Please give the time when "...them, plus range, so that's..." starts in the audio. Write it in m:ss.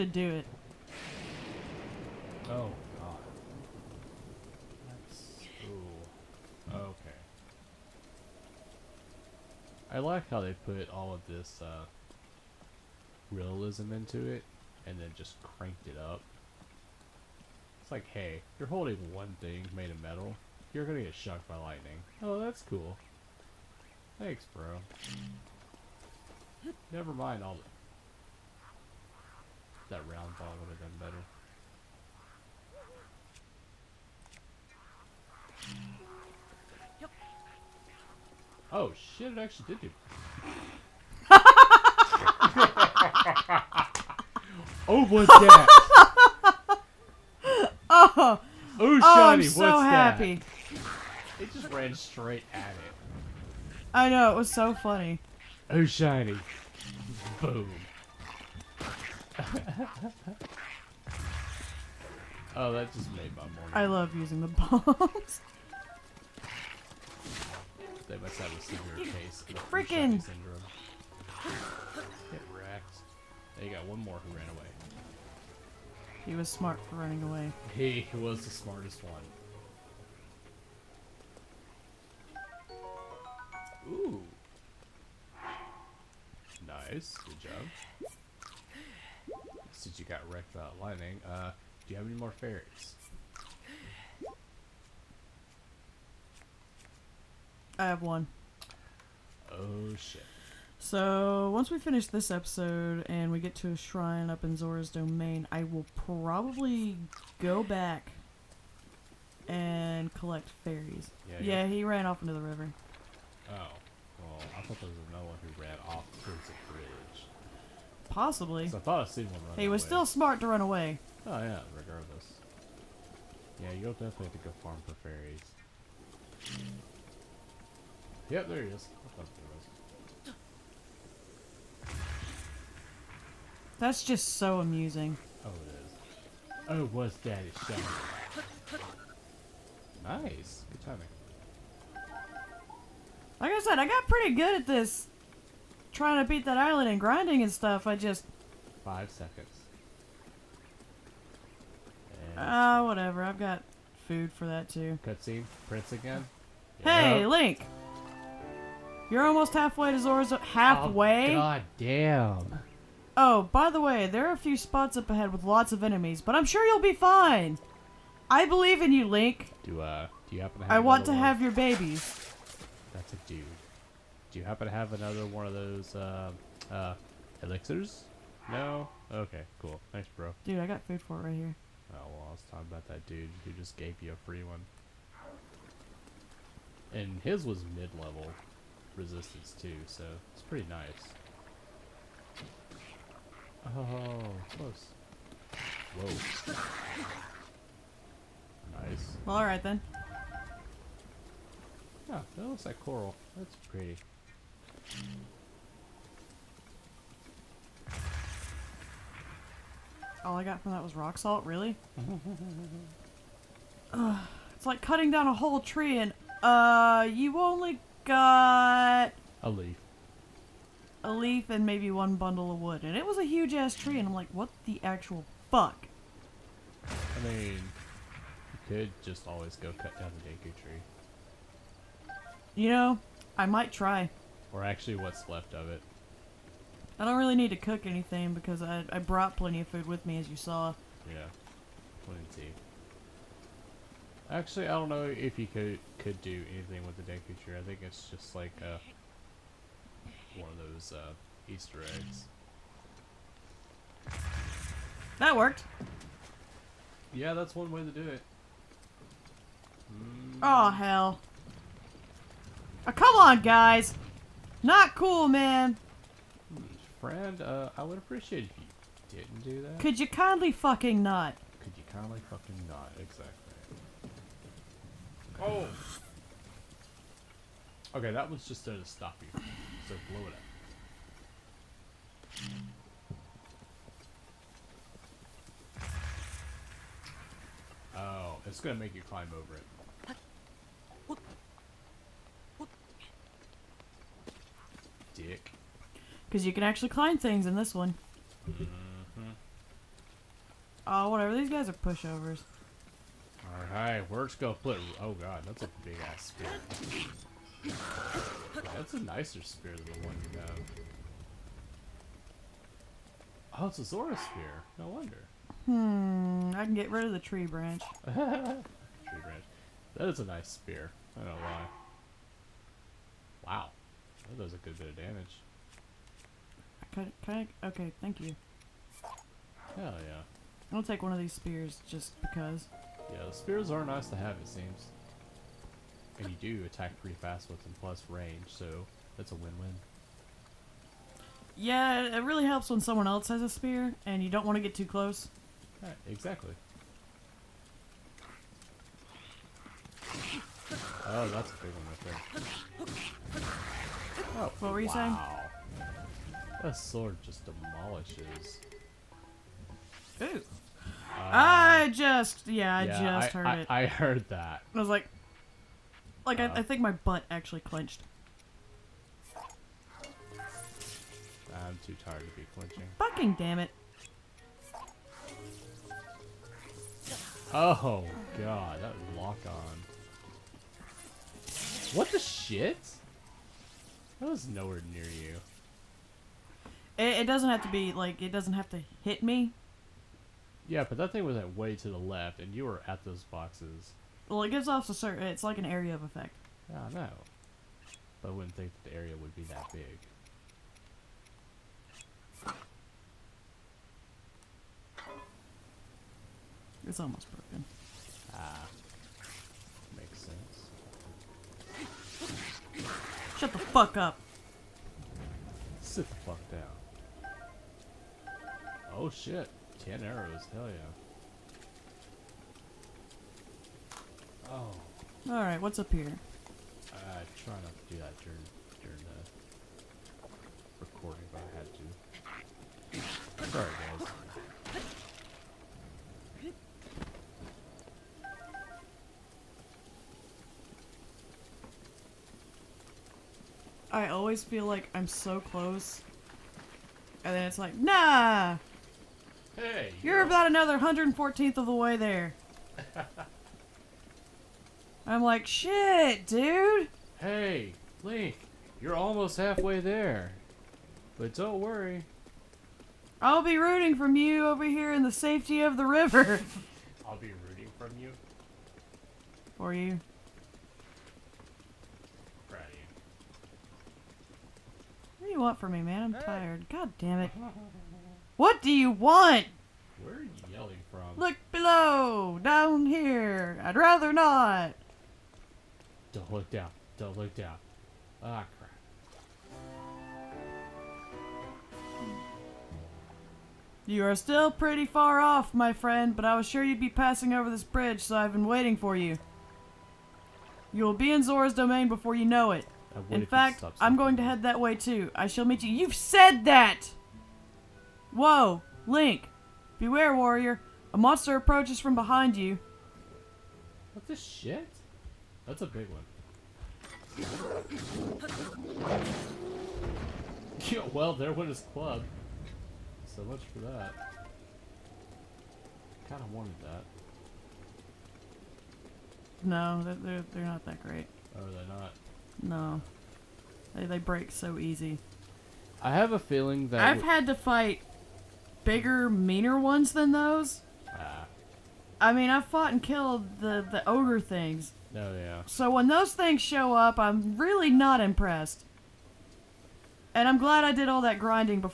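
5:37.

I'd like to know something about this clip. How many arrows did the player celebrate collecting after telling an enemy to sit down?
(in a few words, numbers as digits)
10.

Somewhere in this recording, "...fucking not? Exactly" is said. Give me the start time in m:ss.
4:32.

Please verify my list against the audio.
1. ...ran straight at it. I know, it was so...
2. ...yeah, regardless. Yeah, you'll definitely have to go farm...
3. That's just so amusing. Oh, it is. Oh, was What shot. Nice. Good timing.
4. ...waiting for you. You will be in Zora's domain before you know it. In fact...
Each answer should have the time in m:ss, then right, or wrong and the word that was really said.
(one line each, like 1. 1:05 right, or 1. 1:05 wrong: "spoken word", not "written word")
1. 0:51 right
2. 2:01 right
3. 2:13 wrong: "Daddy", not "What"
4. 8:18 right.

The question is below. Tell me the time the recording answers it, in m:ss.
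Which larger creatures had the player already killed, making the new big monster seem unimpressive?
9:03.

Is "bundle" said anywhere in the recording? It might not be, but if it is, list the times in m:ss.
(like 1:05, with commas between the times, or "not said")
3:42.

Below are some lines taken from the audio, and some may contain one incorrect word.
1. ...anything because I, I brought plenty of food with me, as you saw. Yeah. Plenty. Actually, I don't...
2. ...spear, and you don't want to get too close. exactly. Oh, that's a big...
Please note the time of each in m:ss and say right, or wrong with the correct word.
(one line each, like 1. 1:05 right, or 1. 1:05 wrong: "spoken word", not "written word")
1. 3:57 right
2. 5:43 right.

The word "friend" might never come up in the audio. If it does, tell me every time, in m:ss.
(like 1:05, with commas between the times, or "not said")
4:26, 8:15.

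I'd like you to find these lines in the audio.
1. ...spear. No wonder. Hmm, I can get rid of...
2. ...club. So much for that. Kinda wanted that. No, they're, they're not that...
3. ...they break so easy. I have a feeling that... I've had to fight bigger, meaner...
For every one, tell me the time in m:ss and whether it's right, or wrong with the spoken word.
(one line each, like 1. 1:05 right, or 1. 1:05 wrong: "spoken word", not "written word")
1. 5:14 right
2. 8:41 right
3. 8:53 right.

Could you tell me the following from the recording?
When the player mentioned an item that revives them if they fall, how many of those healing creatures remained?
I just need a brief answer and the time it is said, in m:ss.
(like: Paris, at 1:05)
1, at 1:37.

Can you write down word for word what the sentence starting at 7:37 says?
Hey, Link, you're almost halfway there.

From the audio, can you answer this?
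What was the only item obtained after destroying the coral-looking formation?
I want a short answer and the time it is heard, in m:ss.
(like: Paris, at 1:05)
rock salt, at 3:30.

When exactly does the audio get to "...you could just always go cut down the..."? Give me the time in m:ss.
3:47.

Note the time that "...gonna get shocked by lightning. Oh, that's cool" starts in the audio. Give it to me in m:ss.
0:20.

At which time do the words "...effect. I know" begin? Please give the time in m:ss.
6:36.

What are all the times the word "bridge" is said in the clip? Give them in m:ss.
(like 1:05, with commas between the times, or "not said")
1:56, 8:17.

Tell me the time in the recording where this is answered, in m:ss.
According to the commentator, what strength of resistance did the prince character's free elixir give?
3:07.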